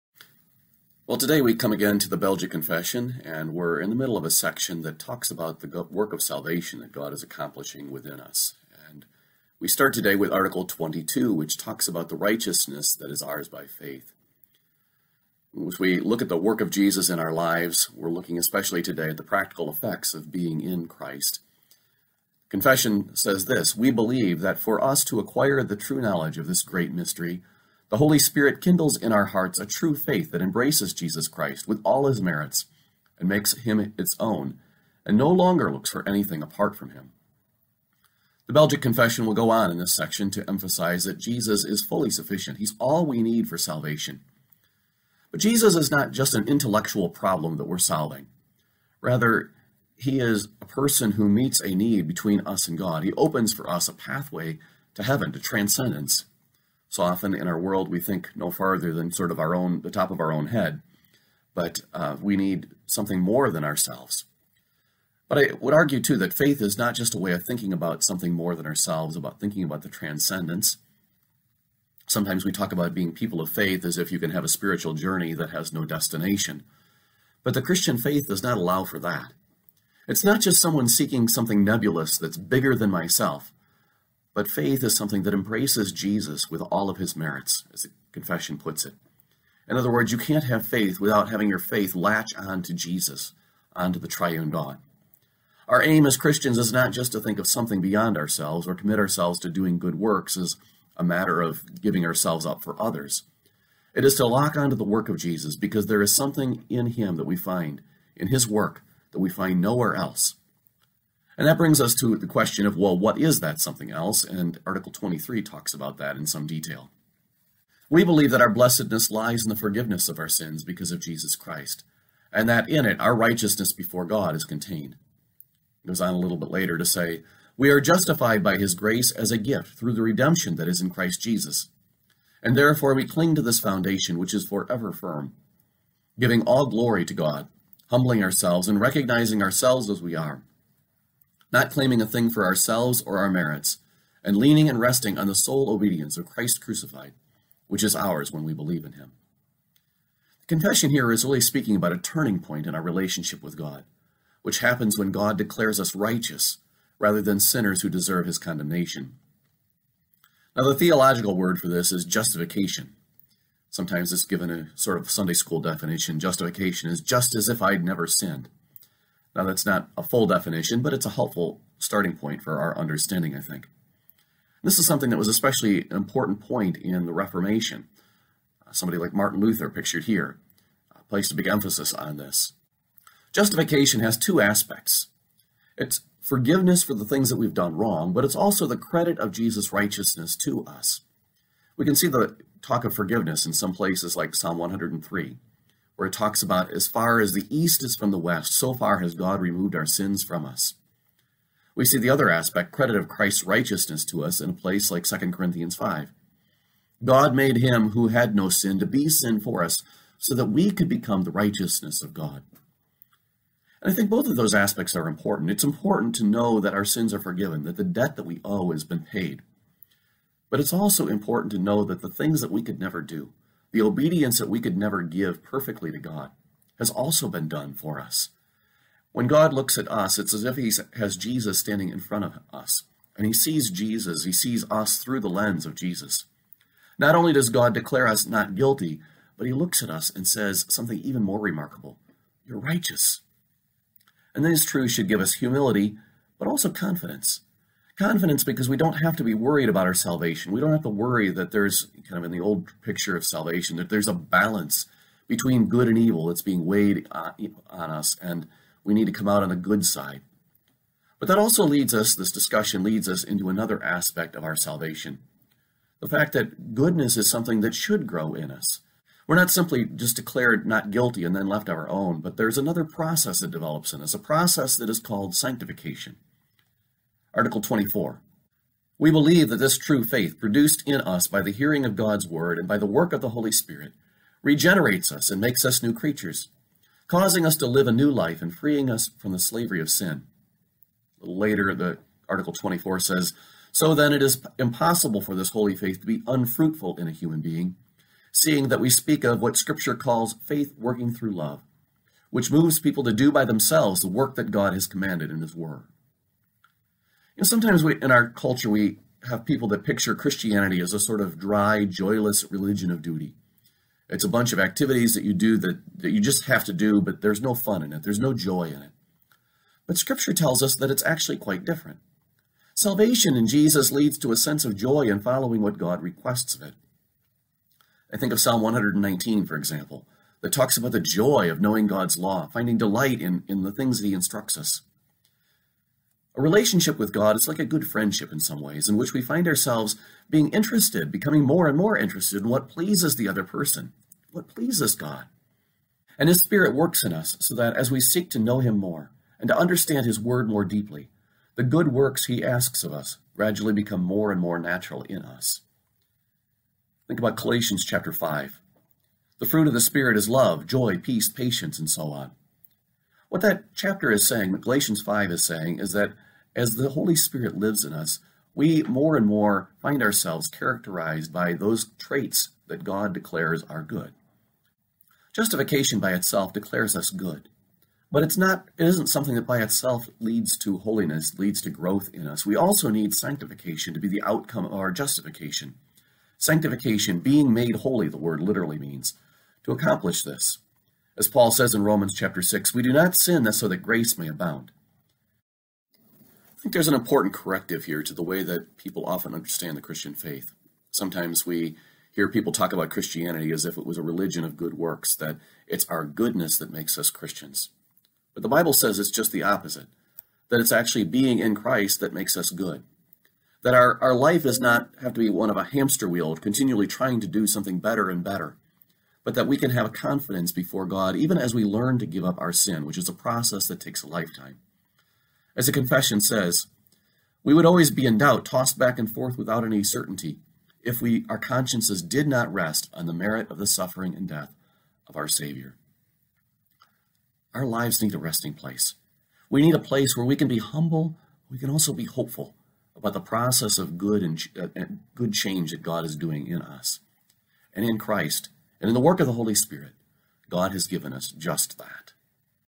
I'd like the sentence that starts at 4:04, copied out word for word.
And this truth should give us humility, but also confidence confidence because we don't have to be worried about our salvation.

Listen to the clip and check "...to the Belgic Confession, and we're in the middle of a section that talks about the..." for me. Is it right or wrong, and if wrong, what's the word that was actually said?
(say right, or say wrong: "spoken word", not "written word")
right.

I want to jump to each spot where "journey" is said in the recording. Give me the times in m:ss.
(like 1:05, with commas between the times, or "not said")
1:14.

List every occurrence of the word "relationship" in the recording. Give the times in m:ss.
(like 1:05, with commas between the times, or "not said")
2:32, 5:36.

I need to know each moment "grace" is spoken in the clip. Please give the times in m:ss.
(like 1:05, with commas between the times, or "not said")
2:08, 6:33.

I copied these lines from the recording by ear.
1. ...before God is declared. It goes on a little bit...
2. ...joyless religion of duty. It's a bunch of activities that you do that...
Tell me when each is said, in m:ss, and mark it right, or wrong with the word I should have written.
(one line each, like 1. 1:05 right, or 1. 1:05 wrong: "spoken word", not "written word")
1. 2:03 wrong: "contained", not "declared"
2. 5:11 right.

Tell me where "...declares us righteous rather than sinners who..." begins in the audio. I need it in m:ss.
2:35.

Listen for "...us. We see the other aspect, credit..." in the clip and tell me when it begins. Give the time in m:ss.
3:20.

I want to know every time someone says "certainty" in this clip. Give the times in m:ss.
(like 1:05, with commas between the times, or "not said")
7:09.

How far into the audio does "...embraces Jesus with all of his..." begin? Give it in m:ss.
1:25.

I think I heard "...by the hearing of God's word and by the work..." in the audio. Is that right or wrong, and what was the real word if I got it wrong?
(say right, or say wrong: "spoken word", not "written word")
right.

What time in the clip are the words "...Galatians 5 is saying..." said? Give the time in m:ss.
6:04.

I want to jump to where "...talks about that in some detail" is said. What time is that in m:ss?
1:55.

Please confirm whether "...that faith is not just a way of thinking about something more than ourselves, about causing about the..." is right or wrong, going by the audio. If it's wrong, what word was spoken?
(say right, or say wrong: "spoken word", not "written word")
wrong: "thinking", not "causing".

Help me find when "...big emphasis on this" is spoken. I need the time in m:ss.
3:01.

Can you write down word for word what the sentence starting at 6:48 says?
But the Bible says it's just the opposite, that it's actually being in Christ that makes us good.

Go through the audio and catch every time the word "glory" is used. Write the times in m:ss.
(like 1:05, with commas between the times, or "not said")
2:16.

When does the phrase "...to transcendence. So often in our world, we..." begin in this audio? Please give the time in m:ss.
0:55.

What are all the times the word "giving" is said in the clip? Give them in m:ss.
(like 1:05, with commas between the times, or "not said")
1:41, 2:16.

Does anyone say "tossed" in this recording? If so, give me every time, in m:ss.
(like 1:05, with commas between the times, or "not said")
7:08.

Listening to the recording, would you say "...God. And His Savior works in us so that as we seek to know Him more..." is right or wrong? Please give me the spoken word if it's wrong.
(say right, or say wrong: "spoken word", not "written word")
wrong: "Spirit", not "Savior".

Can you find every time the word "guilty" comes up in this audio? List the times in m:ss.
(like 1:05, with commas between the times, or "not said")
3:58, 4:30.